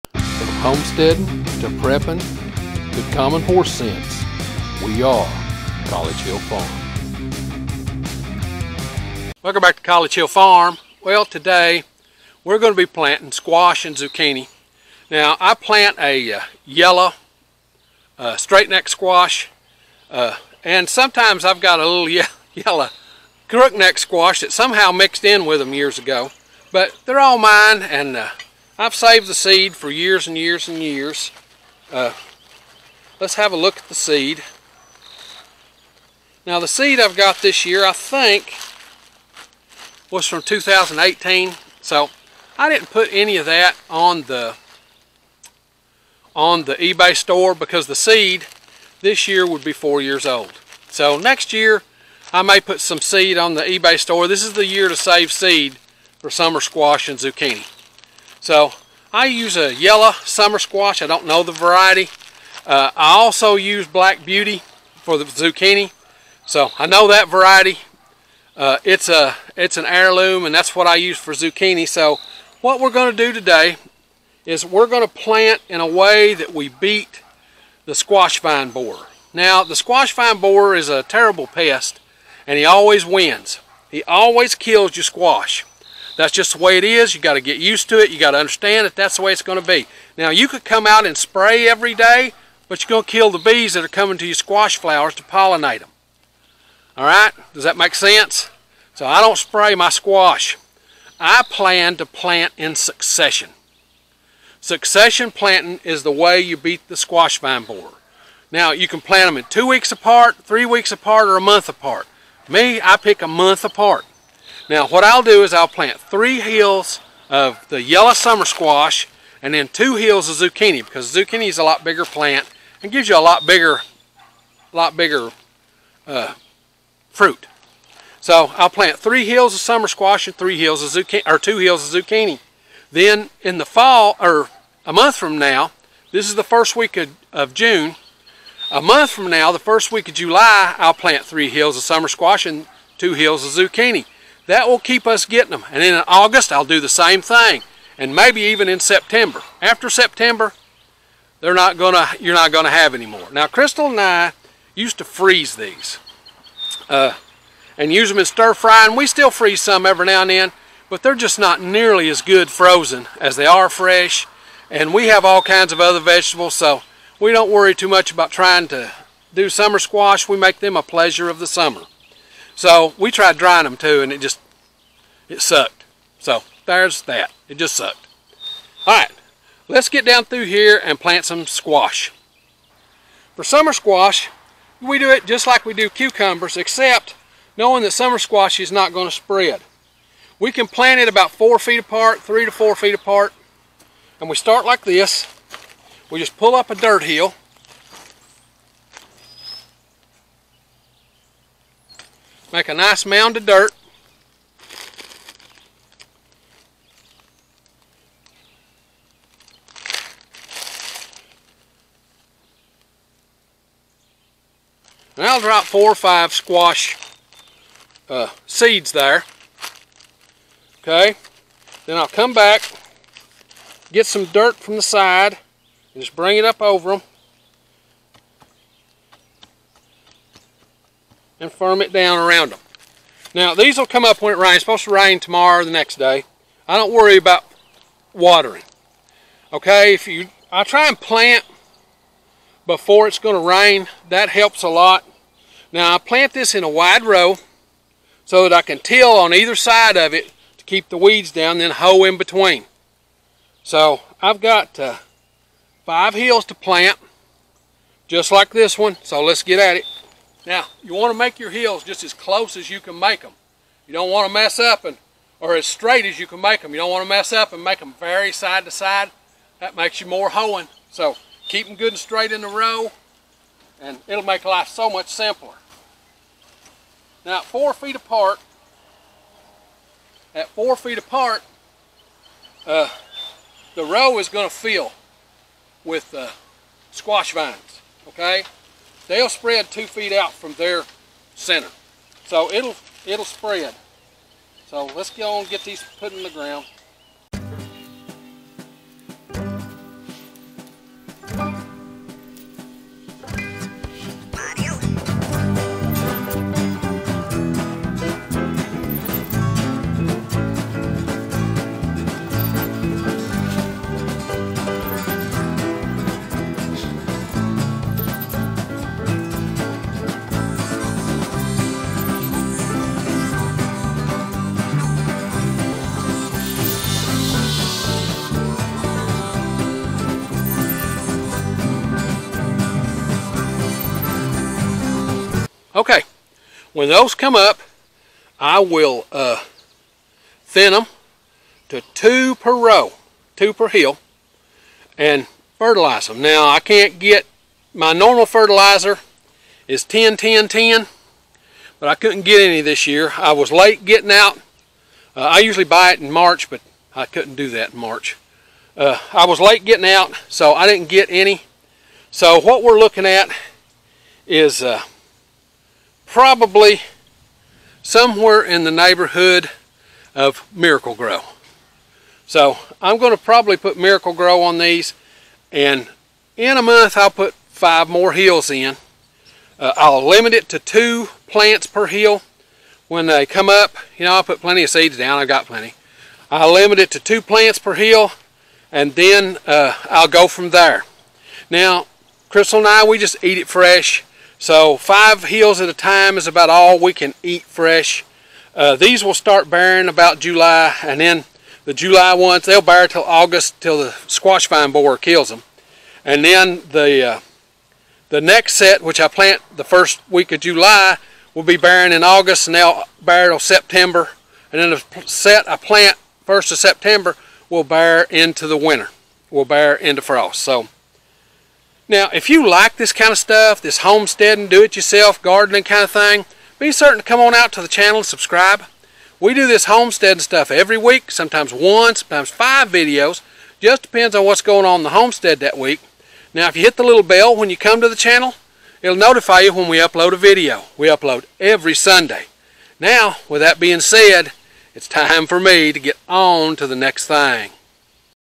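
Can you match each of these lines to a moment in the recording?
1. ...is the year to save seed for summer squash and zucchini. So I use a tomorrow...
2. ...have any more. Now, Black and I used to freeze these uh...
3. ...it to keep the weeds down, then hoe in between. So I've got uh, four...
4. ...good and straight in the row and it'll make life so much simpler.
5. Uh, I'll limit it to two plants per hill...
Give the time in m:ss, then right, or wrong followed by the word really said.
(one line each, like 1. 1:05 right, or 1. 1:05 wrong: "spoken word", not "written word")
1. 0:54 wrong: "yellow", not "tomorrow"
2. 2:32 wrong: "Crystal", not "Black"
3. 4:10 wrong: "five", not "four"
4. 4:31 right
5. 6:19 right.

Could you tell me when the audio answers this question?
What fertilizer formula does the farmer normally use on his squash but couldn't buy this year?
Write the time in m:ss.
5:49.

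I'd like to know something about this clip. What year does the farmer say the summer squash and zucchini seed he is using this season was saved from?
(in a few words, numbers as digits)
2018.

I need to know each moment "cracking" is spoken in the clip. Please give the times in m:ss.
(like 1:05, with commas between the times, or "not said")
not said.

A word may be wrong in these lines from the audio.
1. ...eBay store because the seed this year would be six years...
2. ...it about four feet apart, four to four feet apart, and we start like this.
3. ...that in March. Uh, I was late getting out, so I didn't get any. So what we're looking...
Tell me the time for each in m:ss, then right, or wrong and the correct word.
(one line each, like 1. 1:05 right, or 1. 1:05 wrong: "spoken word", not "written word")
1. 0:46 wrong: "four", not "six"
2. 3:10 wrong: "three", not "four"
3. 5:57 right.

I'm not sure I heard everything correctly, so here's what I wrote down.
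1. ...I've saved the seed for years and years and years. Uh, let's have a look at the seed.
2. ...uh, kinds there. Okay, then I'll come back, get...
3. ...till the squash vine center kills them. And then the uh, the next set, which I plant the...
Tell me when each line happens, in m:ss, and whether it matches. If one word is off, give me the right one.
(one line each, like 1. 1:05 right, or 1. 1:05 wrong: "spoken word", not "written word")
1. 0:28 right
2. 3:38 wrong: "seeds", not "kinds"
3. 6:43 wrong: "borer", not "center".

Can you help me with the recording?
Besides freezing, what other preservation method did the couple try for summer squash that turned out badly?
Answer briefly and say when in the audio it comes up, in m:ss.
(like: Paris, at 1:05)
Drying, at 2:53.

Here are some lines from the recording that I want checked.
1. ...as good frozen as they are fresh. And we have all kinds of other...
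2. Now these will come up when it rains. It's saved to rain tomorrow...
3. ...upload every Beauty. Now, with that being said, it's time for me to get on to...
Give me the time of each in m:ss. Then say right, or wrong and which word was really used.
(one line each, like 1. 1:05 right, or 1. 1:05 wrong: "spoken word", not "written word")
1. 2:42 right
2. 3:53 wrong: "supposed", not "saved"
3. 7:20 wrong: "Sunday", not "Beauty".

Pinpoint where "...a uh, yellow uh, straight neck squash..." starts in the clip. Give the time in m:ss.
0:15.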